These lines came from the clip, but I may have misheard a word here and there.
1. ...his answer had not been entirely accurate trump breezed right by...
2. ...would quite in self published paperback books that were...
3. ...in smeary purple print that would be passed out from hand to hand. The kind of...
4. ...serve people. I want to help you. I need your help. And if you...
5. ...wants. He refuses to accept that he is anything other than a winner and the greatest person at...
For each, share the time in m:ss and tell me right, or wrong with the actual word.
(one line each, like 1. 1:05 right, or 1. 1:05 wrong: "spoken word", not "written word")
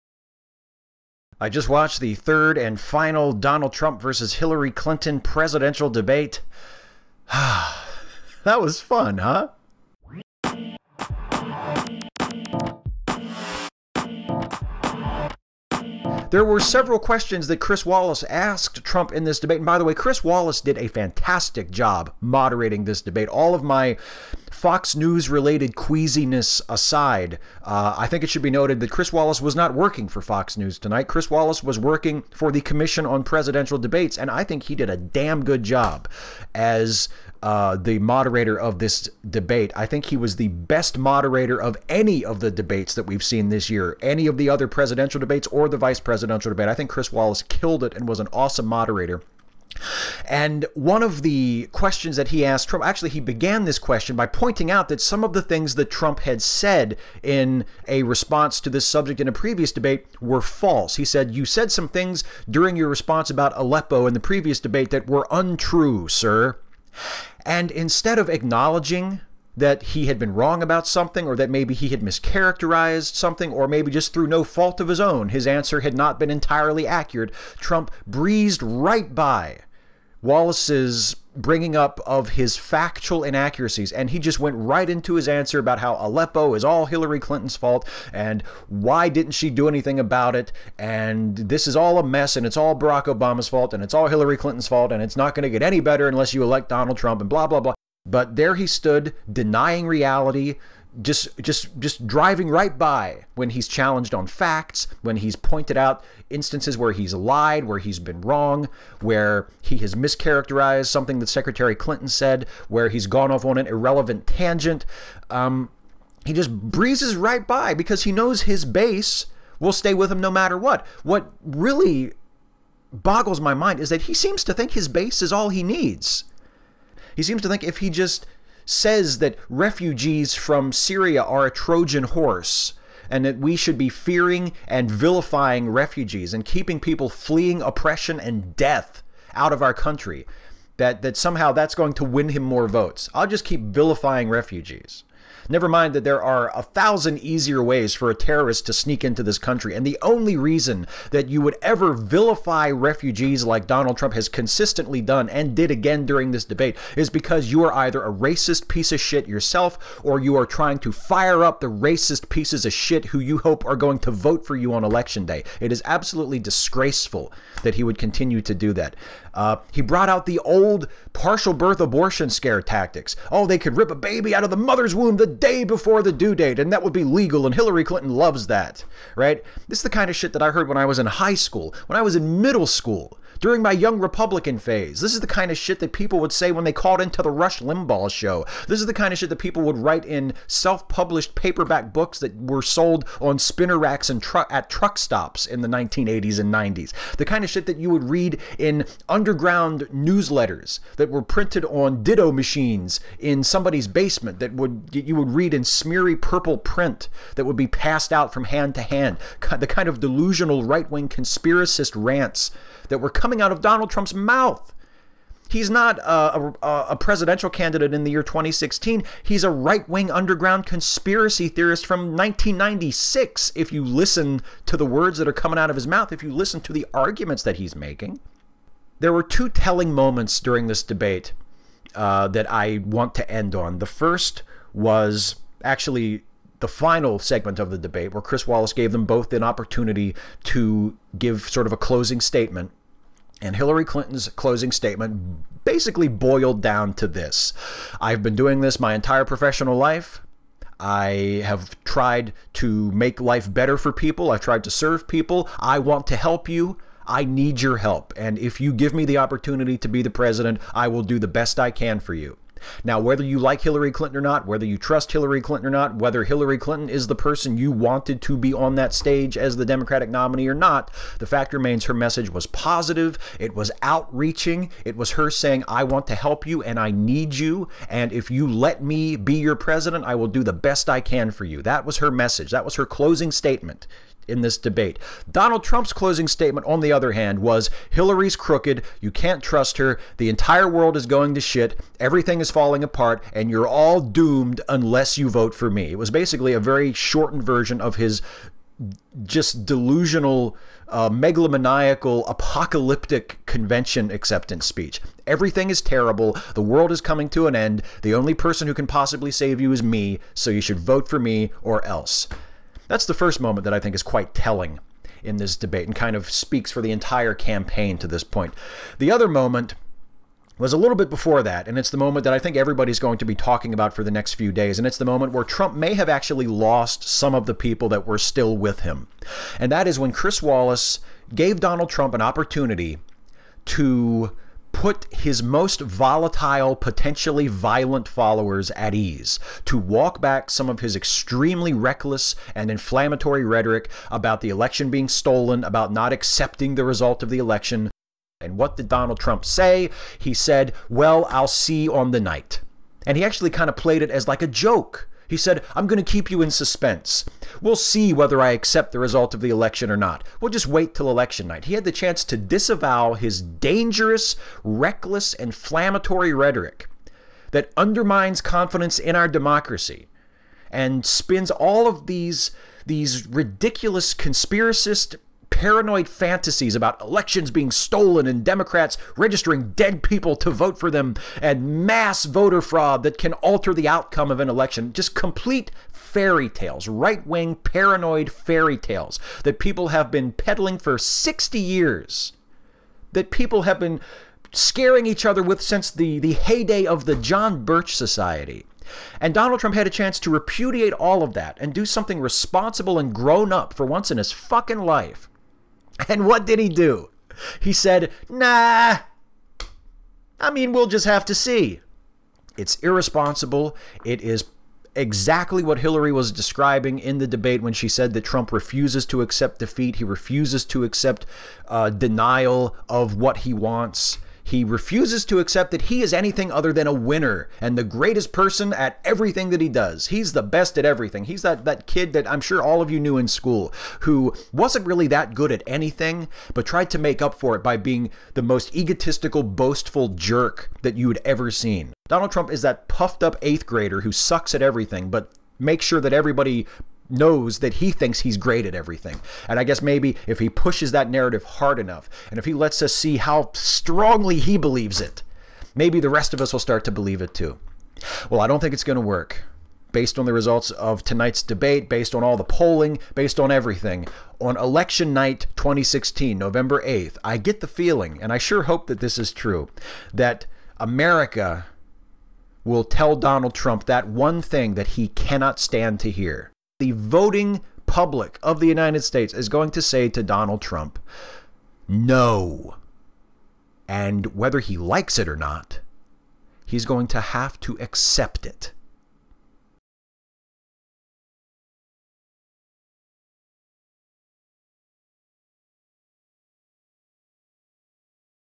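1. 1:15 right
2. 3:09 wrong: "write", not "quite"
3. 3:25 right
4. 4:14 right
5. 7:03 right.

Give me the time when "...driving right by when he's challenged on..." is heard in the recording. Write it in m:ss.
1:42.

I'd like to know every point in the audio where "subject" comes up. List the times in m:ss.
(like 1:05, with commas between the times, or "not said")
0:58.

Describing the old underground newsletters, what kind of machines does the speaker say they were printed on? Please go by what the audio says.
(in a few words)
ditto machines.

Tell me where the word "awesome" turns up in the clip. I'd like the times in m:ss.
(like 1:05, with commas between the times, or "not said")
0:48.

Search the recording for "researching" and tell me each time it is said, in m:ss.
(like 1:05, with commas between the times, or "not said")
not said.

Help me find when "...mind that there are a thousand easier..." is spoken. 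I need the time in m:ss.
2:25.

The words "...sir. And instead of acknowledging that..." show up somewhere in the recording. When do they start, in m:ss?
1:06.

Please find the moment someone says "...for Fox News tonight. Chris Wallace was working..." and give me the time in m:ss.
0:30.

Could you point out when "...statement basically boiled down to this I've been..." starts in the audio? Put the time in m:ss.
4:04.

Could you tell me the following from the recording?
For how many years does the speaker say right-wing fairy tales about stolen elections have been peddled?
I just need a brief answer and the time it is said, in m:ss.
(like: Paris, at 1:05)
60, at 6:30.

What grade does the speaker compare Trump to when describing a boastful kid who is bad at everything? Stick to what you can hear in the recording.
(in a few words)
eighth grader.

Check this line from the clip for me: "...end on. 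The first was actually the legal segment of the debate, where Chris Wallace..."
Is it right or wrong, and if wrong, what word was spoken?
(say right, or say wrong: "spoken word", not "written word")
wrong: "final", not "legal".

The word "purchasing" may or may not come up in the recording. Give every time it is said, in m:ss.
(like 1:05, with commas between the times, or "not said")
not said.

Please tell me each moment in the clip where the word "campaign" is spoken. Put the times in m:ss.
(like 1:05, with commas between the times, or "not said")
5:17.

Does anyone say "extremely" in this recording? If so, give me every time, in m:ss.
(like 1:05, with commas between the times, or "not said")
5:40.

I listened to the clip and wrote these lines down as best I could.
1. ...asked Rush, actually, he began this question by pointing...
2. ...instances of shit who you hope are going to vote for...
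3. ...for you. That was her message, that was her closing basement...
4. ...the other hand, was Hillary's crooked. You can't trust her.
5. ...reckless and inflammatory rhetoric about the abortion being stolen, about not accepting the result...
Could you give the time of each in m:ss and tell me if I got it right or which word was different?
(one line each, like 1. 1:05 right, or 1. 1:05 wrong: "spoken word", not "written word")
1. 0:52 wrong: "Trump", not "Rush"
2. 2:42 wrong: "pieces", not "instances"
3. 4:41 wrong: "statement", not "basement"
4. 4:46 right
5. 5:41 wrong: "election", not "abortion".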